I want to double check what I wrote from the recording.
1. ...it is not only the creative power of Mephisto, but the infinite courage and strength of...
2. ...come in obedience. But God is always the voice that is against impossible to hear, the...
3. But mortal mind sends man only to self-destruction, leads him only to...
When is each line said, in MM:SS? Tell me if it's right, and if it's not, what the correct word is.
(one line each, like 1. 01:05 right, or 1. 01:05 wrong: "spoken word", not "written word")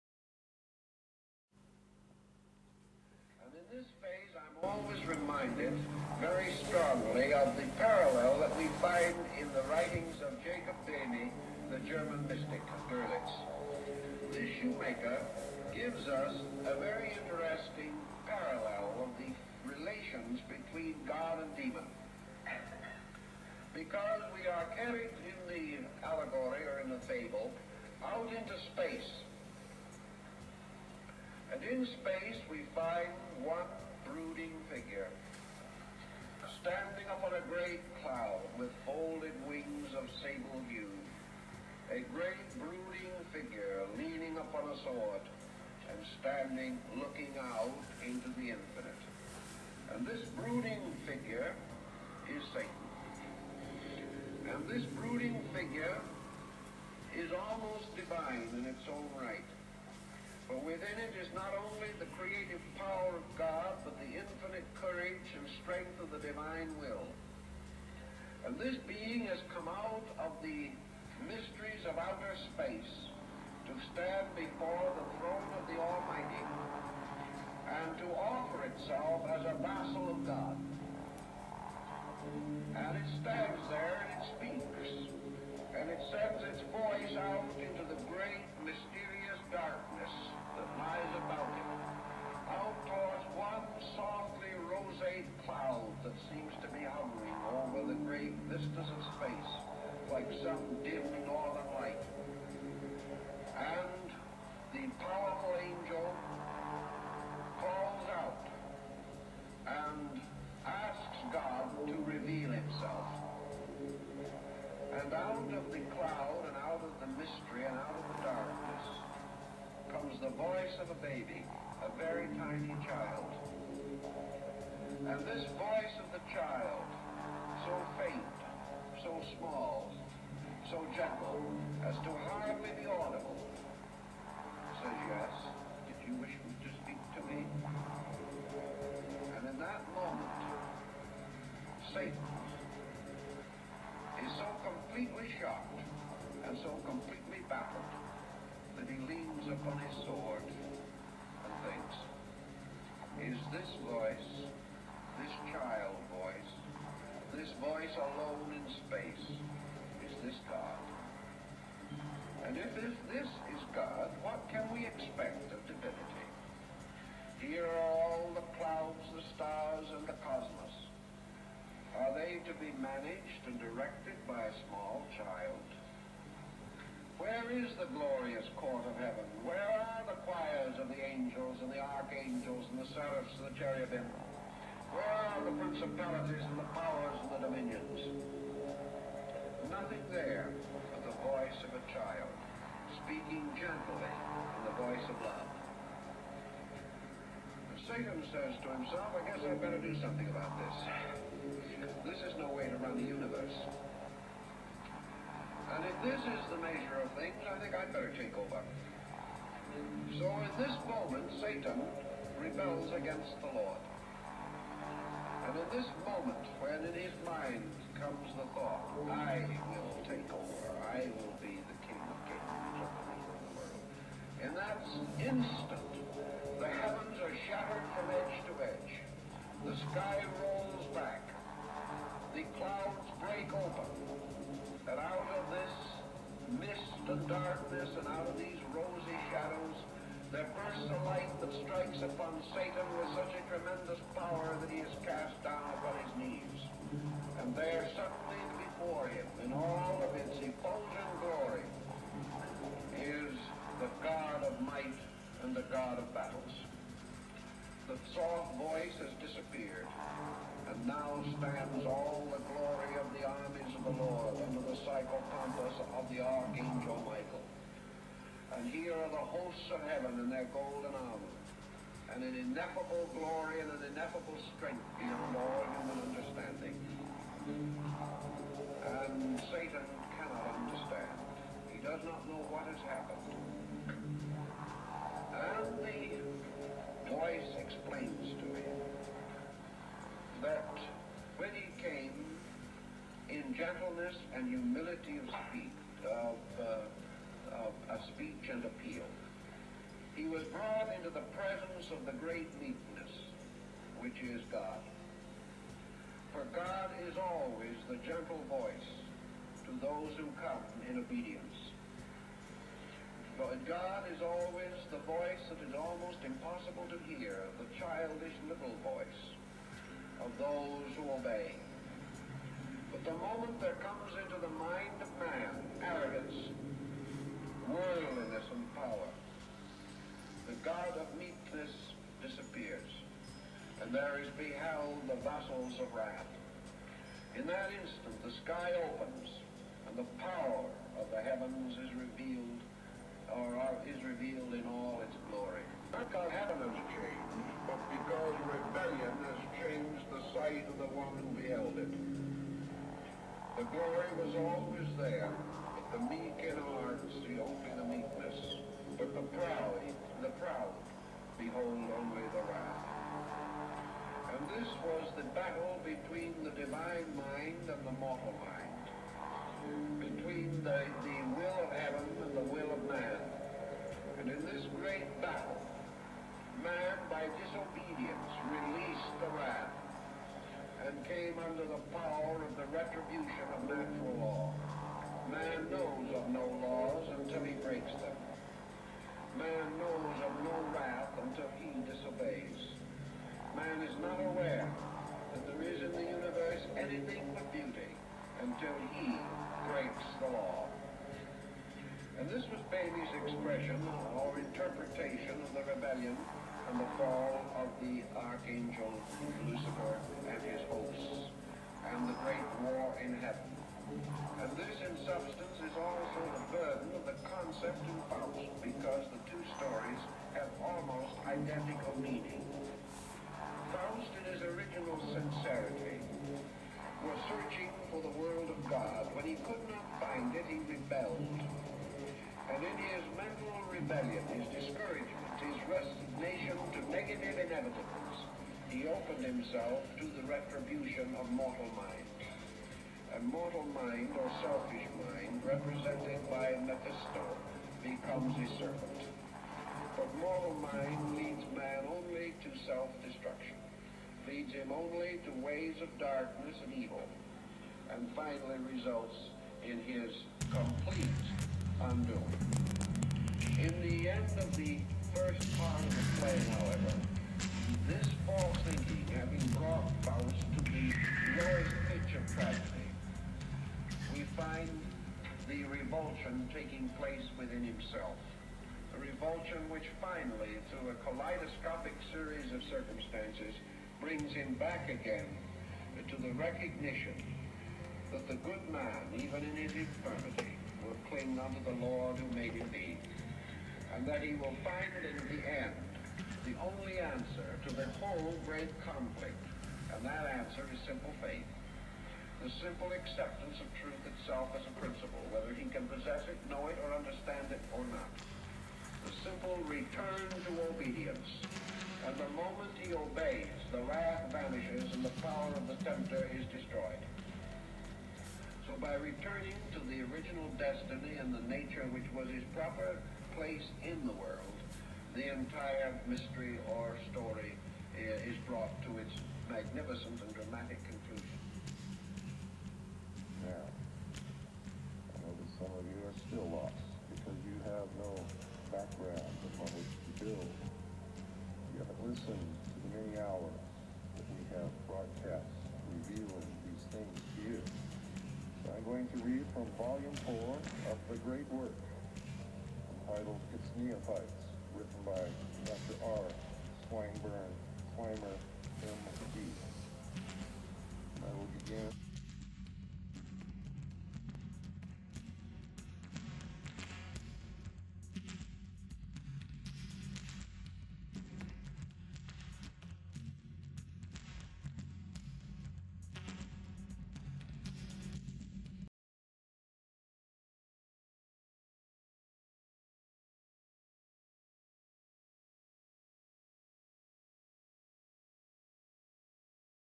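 1. 01:00 wrong: "God", not "Mephisto"
2. 05:10 wrong: "almost", not "against"
3. 07:29 wrong: "leads", not "sends".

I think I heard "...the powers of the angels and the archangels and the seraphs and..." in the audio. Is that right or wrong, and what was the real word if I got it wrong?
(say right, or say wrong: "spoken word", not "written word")
wrong: "choirs", not "powers".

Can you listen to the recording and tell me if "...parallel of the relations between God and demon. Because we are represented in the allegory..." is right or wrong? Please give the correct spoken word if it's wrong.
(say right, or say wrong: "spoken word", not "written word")
wrong: "carried", not "represented".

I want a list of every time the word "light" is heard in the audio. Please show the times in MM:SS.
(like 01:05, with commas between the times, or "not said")
04:01.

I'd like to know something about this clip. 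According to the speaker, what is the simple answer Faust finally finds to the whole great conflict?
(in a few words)
Simple faith.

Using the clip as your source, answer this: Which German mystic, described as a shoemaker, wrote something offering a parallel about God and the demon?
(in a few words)
Jacob Boehme.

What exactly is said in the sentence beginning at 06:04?
And this was the battle between the divine mind and the mortal mind.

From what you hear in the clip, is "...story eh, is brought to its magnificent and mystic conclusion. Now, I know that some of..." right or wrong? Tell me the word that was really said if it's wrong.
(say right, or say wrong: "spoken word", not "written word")
wrong: "dramatic", not "mystic".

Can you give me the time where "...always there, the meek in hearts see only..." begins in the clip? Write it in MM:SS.
05:54.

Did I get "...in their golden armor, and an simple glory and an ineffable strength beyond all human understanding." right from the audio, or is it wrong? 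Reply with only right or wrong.
wrong.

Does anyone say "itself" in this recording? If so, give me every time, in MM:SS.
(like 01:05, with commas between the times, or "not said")
01:18, 08:24.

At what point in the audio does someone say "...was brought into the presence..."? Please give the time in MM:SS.
05:00.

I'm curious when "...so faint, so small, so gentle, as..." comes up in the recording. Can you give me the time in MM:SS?
02:07.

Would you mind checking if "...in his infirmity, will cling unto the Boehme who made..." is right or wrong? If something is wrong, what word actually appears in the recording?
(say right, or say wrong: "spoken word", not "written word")
wrong: "Lord", not "Boehme".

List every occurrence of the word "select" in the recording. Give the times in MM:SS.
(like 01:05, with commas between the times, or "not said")
not said.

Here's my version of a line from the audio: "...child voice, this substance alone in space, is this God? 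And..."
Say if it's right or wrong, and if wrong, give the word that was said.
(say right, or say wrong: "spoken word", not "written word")
wrong: "voice", not "substance".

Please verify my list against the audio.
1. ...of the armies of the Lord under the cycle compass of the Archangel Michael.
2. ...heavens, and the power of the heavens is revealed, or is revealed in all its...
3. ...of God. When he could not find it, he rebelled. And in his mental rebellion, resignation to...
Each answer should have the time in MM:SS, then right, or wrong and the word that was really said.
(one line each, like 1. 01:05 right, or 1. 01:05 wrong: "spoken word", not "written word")
1. 04:22 right
2. 05:38 wrong: "opens", not "heavens"
3. 07:08 right.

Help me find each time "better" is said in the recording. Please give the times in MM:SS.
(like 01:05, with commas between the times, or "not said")
03:19, 03:27.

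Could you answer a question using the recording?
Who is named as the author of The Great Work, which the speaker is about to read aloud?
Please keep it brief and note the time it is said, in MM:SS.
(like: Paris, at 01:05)
R. Swinburne Clymer, at 09:16.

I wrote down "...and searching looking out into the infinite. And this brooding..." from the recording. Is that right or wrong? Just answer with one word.
wrong.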